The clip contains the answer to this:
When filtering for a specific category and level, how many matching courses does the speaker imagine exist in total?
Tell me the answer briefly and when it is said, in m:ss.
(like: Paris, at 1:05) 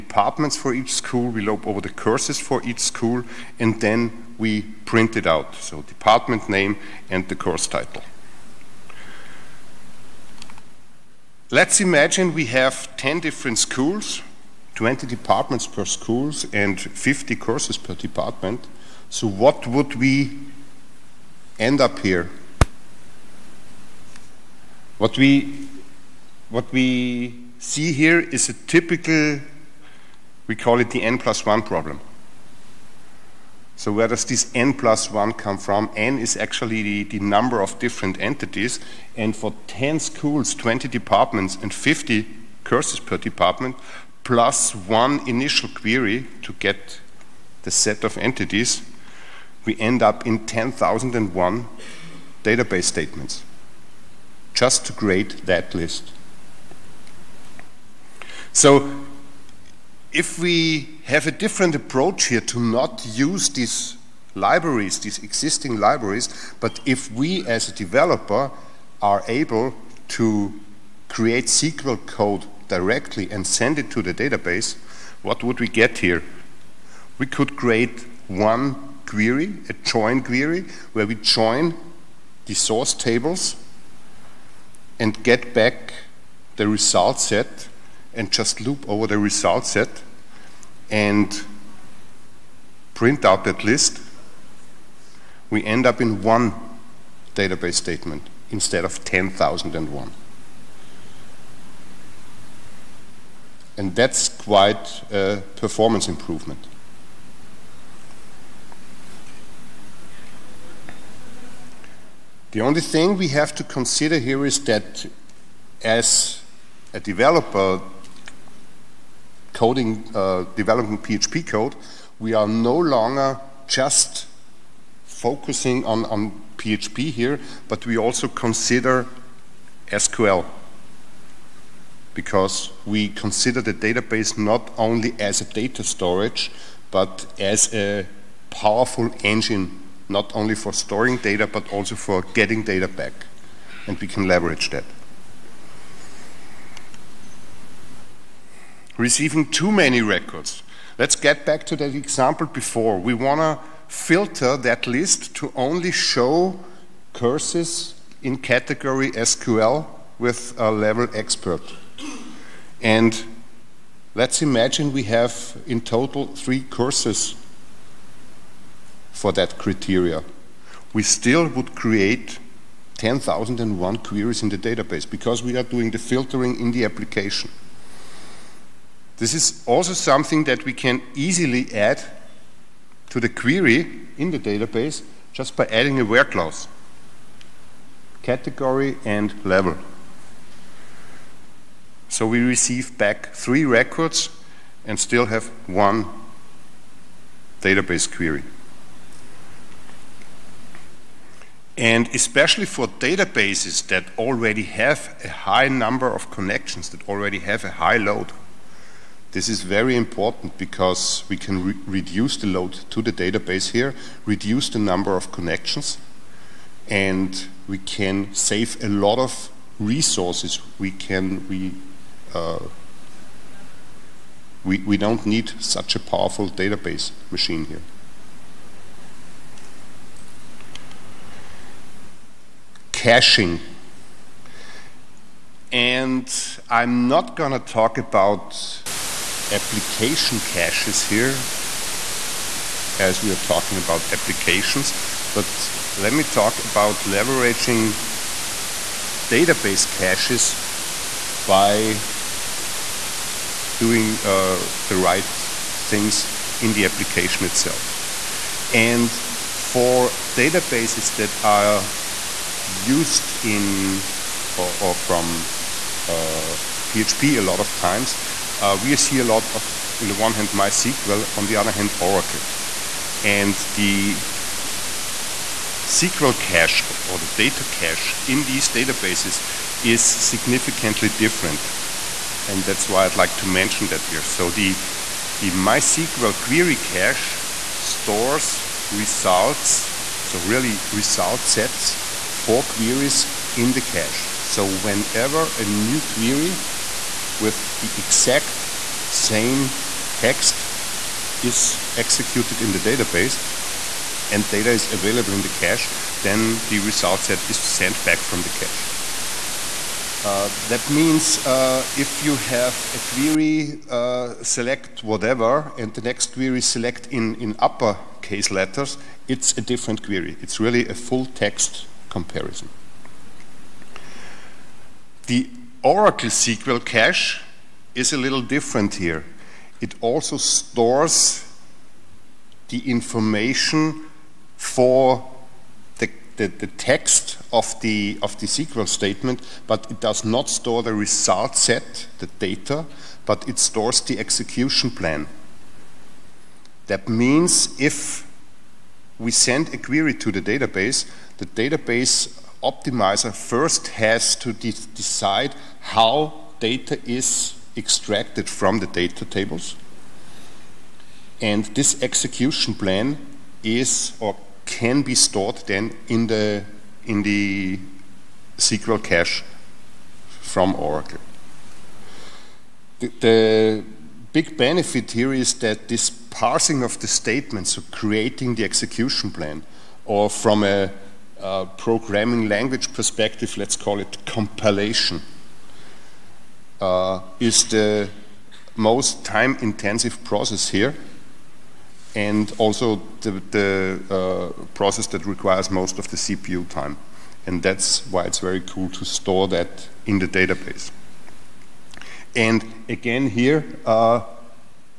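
3, at 2:46.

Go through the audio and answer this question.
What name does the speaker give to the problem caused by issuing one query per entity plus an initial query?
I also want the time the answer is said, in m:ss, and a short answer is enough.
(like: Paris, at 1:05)
n plus 1 problem, at 0:31.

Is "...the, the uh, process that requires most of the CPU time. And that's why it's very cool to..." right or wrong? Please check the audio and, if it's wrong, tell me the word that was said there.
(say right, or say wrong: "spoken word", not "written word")
right.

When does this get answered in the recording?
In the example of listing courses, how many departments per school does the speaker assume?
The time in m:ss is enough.
0:14.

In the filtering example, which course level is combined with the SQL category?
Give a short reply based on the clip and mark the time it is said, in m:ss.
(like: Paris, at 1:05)
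expert, at 2:41.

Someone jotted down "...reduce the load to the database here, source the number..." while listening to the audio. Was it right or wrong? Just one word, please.
wrong.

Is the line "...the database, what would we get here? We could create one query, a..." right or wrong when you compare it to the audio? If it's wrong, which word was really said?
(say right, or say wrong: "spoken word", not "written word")
right.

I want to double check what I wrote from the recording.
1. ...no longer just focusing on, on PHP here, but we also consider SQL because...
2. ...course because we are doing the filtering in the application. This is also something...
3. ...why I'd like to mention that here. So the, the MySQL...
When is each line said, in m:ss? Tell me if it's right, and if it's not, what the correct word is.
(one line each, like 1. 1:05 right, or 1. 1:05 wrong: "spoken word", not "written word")
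1. 2:02 right
2. 2:54 wrong: "database", not "course"
3. 4:42 right.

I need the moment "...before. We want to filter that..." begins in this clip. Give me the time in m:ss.
2:32.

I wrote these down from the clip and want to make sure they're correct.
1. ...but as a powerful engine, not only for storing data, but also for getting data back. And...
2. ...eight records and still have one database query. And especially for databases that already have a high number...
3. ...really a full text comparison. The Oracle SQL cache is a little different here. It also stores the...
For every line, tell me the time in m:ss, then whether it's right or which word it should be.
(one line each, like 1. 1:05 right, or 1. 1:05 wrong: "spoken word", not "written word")
1. 2:16 right
2. 3:13 wrong: "three", not "eight"
3. 5:20 right.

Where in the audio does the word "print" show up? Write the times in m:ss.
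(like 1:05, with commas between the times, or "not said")
0:04, 1:32.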